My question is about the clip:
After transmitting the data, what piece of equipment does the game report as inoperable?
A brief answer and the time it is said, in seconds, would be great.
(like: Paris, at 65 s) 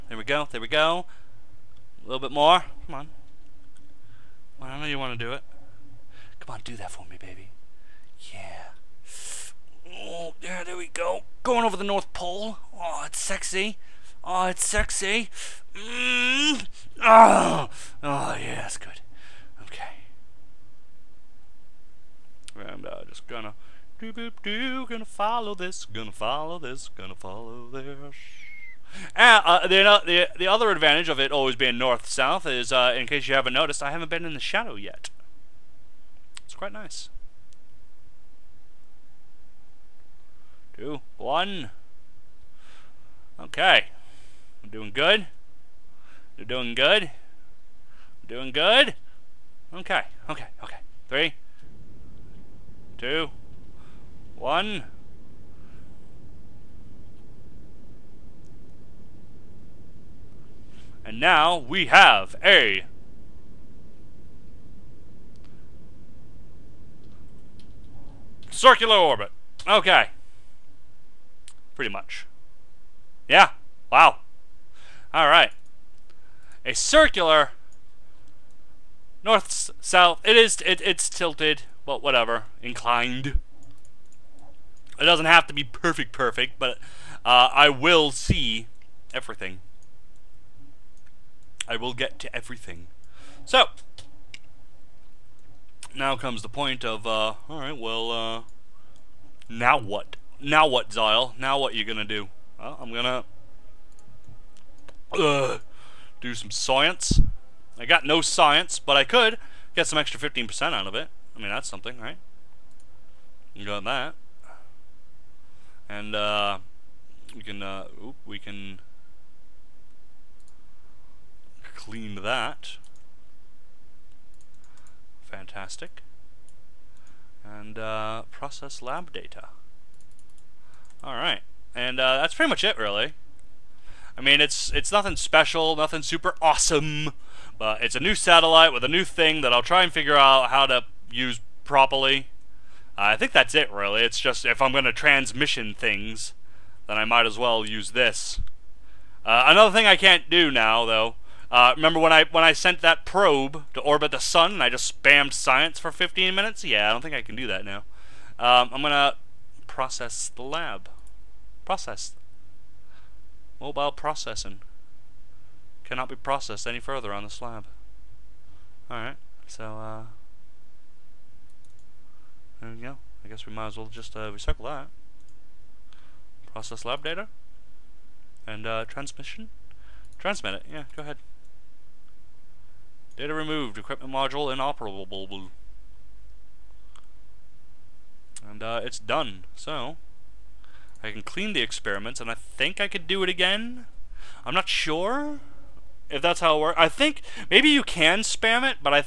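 Equipment module, at 183 s.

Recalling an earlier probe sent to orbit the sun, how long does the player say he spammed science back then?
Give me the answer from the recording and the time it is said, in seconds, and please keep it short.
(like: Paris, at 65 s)
15 minutes, at 155 s.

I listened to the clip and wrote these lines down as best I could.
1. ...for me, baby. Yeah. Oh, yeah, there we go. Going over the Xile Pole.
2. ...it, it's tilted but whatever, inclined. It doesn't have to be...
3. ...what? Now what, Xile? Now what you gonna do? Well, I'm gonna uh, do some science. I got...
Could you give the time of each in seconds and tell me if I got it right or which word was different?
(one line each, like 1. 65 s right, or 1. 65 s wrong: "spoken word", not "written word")
1. 6 s wrong: "North", not "Xile"
2. 80 s right
3. 99 s right.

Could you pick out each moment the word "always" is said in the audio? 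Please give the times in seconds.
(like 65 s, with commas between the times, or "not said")
31 s.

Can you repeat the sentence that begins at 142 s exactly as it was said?
Uh, I think that's it, really.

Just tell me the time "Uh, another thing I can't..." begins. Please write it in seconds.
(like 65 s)
149 s.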